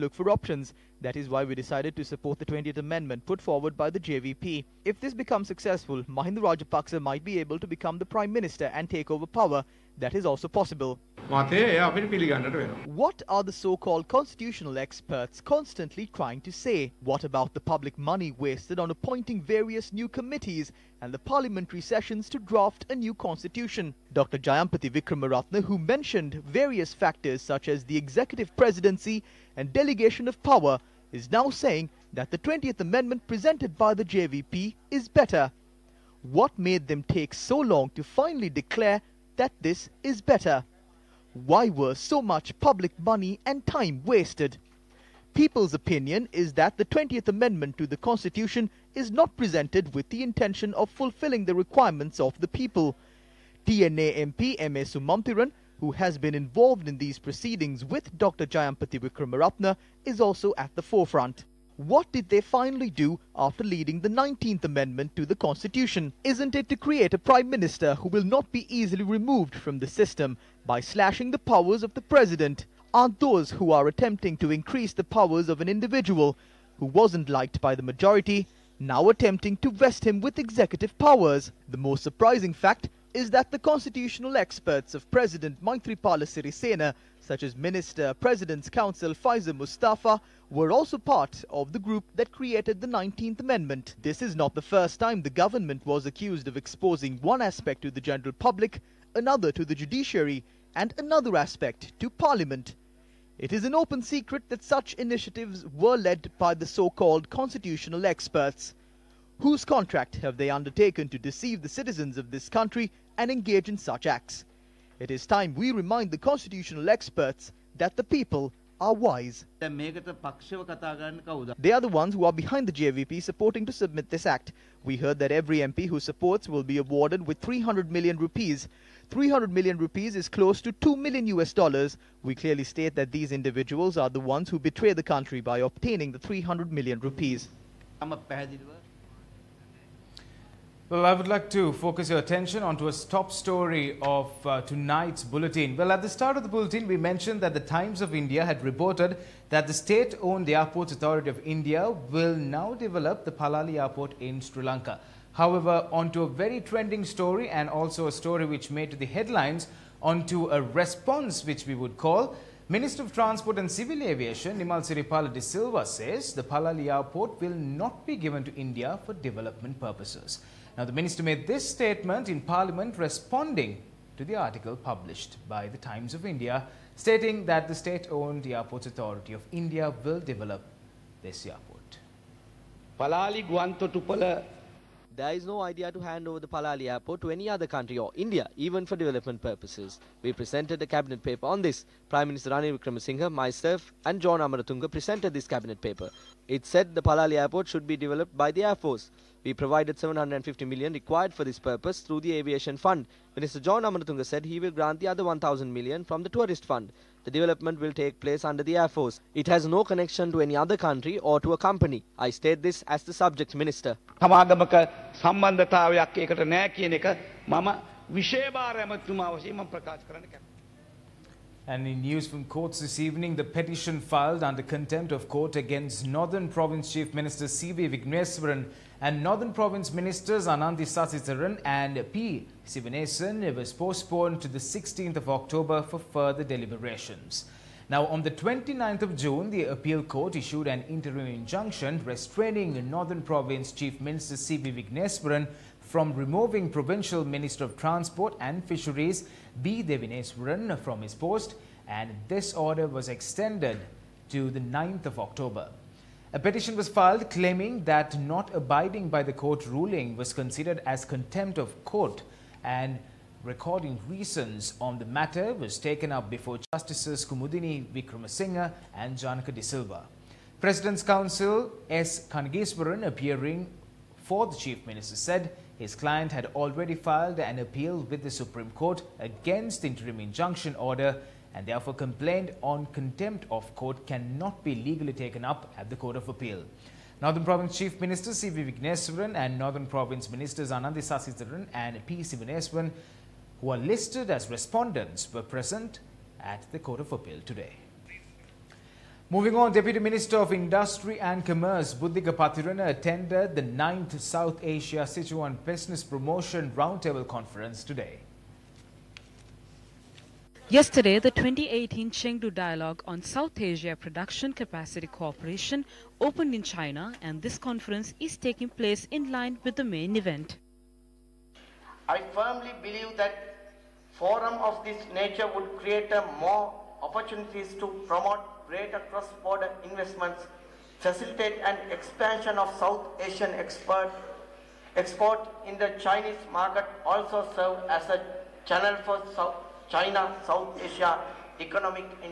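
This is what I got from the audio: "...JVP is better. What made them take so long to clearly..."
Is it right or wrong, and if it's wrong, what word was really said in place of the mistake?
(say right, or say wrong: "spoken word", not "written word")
wrong: "finally", not "clearly".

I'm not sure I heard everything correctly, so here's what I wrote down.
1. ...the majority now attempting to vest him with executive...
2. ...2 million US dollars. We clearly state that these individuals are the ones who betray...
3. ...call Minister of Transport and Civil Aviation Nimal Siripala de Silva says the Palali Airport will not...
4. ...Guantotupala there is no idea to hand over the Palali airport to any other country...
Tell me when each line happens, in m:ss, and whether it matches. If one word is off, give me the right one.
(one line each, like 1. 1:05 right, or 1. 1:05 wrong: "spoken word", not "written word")
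1. 1:17 right
2. 2:10 right
3. 2:41 right
4. 3:03 right.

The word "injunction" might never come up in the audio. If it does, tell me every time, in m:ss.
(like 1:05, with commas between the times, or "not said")
4:01, 4:40.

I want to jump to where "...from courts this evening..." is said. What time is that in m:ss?
3:42.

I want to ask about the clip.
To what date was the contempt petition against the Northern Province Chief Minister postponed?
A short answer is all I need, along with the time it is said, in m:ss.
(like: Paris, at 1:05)
16 October, at 3:54.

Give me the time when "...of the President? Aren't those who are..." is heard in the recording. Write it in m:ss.
1:11.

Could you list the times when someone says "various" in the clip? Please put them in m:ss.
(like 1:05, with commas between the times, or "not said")
0:19, 0:26.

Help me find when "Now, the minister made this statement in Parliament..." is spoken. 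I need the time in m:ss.
2:50.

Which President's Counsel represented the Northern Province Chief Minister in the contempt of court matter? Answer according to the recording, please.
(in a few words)
S. Kanageswaran.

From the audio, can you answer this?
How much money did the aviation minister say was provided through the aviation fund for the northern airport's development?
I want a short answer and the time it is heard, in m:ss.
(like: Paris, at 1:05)
750 million, at 3:19.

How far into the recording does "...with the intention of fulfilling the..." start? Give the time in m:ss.
0:49.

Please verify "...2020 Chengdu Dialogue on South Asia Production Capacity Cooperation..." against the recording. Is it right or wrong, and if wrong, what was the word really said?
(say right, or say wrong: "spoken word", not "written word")
wrong: "2018", not "2020".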